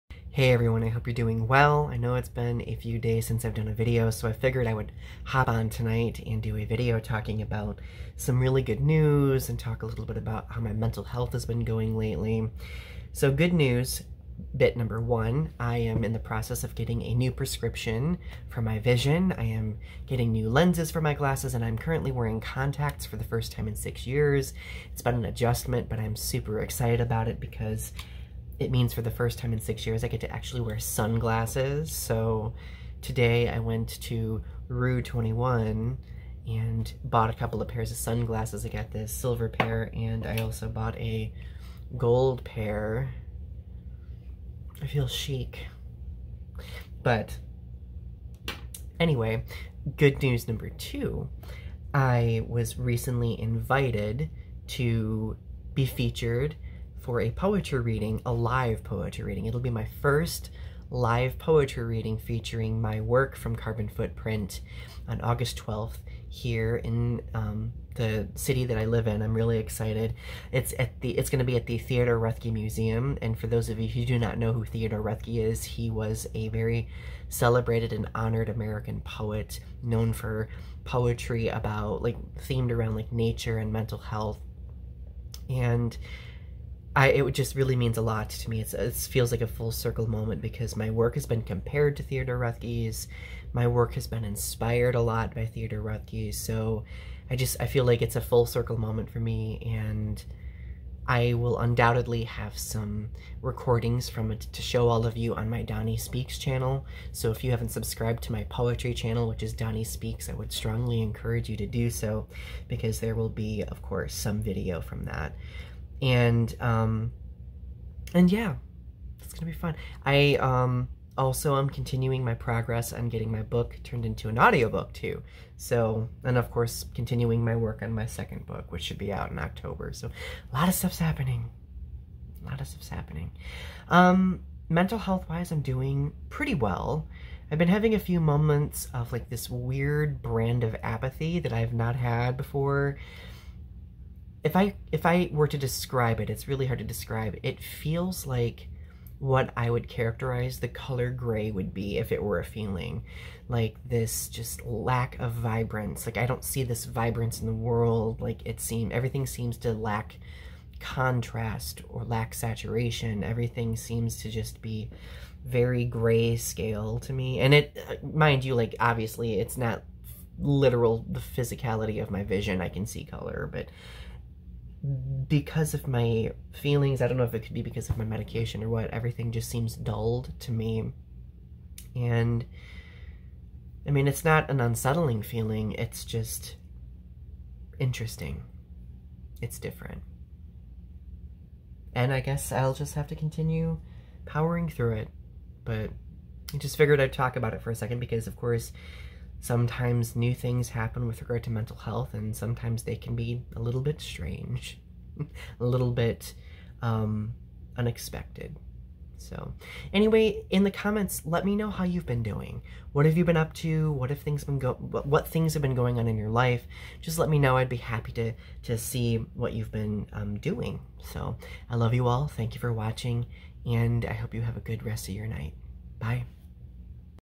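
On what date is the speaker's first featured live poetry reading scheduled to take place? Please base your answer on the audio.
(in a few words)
August 12th.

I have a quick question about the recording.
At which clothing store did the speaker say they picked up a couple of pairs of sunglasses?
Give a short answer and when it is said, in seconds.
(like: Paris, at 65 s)
Rue 21, at 34 s.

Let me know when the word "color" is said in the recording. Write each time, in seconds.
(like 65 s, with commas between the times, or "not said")
150 s, 173 s.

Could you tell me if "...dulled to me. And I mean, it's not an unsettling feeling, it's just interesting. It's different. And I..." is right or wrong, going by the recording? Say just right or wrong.
right.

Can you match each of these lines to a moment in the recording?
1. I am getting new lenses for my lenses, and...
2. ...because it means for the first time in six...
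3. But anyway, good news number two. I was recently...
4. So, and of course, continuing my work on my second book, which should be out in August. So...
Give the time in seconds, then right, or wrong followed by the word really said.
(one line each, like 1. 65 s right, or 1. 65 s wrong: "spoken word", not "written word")
1. 19 s wrong: "glasses", not "lenses"
2. 27 s right
3. 47 s right
4. 125 s wrong: "October", not "August".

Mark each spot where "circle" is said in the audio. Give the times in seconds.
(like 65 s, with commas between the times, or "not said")
89 s, 98 s.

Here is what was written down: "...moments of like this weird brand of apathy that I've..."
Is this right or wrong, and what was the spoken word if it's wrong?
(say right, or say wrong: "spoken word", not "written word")
right.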